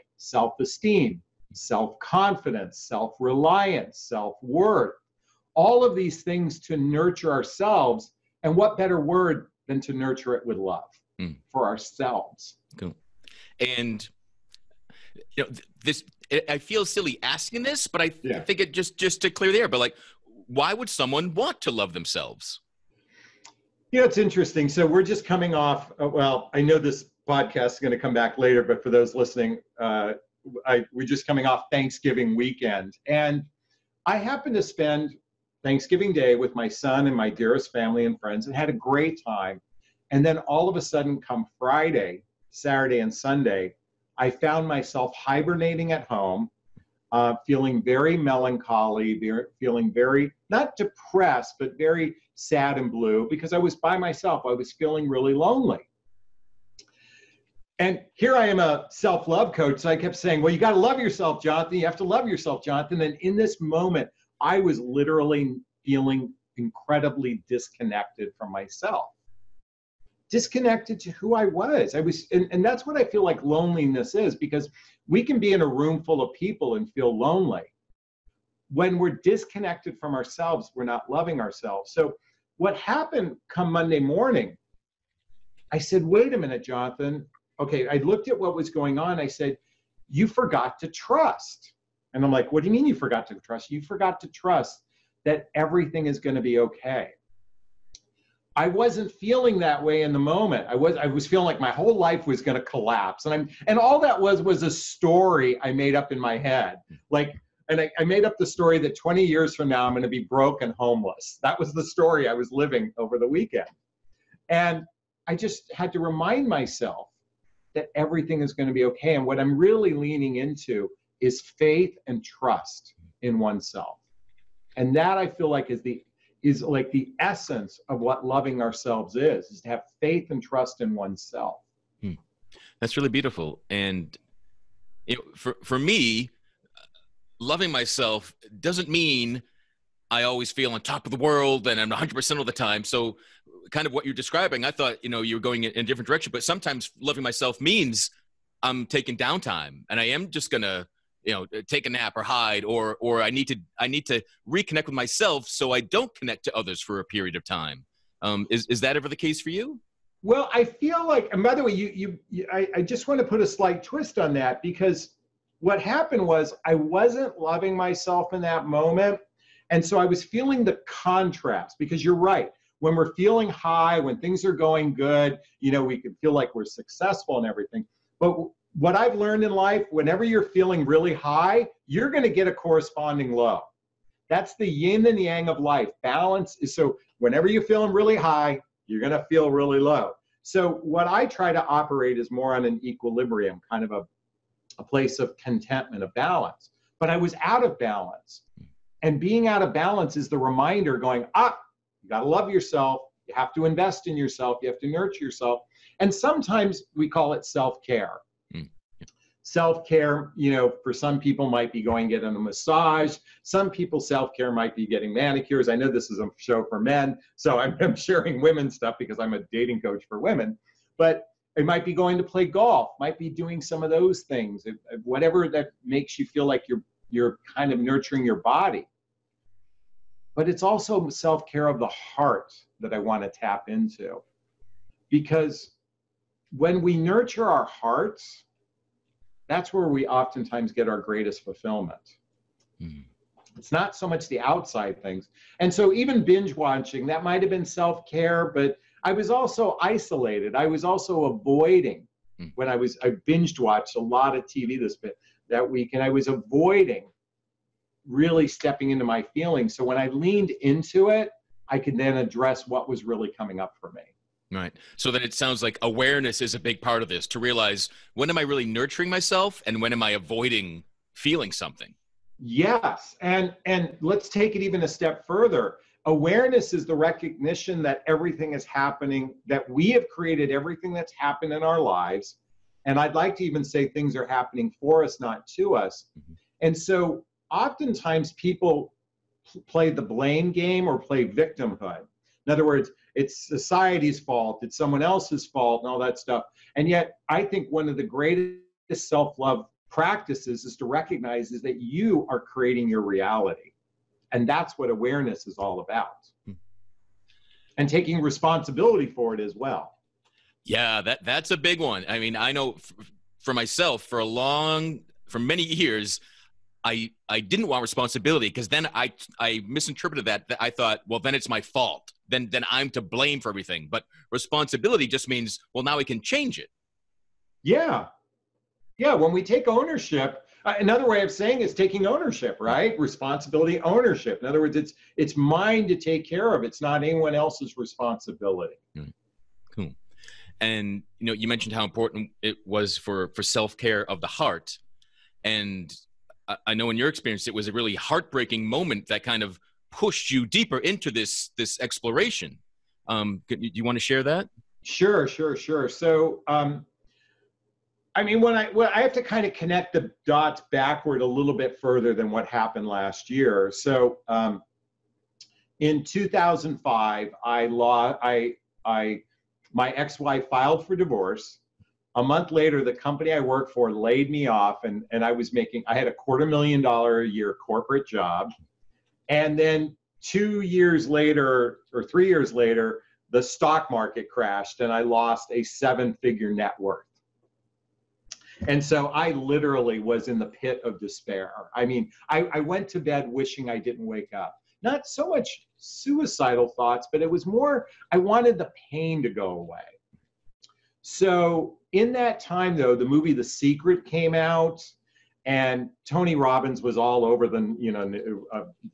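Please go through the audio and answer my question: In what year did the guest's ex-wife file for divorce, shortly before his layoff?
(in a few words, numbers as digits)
2005.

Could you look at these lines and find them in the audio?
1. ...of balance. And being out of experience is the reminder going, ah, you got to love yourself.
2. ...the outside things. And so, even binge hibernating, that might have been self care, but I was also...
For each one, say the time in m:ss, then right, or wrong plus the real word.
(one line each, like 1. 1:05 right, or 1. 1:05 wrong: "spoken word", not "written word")
1. 3:17 wrong: "balance", not "experience"
2. 4:04 wrong: "watching", not "hibernating".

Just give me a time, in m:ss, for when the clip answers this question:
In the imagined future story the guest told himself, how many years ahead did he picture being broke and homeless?
1:48.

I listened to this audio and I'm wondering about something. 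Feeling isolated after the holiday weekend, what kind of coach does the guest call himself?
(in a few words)
Self love coach.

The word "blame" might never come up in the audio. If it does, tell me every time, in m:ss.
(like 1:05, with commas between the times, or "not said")
4:50, 5:23.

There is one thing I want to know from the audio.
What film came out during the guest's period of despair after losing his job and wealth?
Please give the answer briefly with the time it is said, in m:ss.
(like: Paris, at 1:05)
The Secret, at 6:43.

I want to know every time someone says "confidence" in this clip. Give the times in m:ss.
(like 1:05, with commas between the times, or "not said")
0:01.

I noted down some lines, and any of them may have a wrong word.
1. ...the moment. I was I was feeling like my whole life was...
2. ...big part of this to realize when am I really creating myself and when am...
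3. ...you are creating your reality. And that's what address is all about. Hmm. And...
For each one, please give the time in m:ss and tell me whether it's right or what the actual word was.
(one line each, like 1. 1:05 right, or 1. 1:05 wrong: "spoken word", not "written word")
1. 1:40 right
2. 4:26 wrong: "nurturing", not "creating"
3. 5:01 wrong: "awareness", not "address".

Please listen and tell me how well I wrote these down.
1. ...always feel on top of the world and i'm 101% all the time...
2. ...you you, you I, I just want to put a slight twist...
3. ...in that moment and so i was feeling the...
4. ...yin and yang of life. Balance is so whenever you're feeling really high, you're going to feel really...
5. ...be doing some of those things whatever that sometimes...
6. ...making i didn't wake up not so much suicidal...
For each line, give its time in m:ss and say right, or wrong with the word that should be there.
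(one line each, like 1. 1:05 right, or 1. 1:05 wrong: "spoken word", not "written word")
1. 2:20 wrong: "100", not "101"
2. 2:41 right
3. 2:48 right
4. 3:04 right
5. 3:43 wrong: "makes", not "sometimes"
6. 6:33 wrong: "wishing", not "making".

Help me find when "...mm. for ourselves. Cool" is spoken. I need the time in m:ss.
0:11.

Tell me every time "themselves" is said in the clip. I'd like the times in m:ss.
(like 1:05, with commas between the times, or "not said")
0:21.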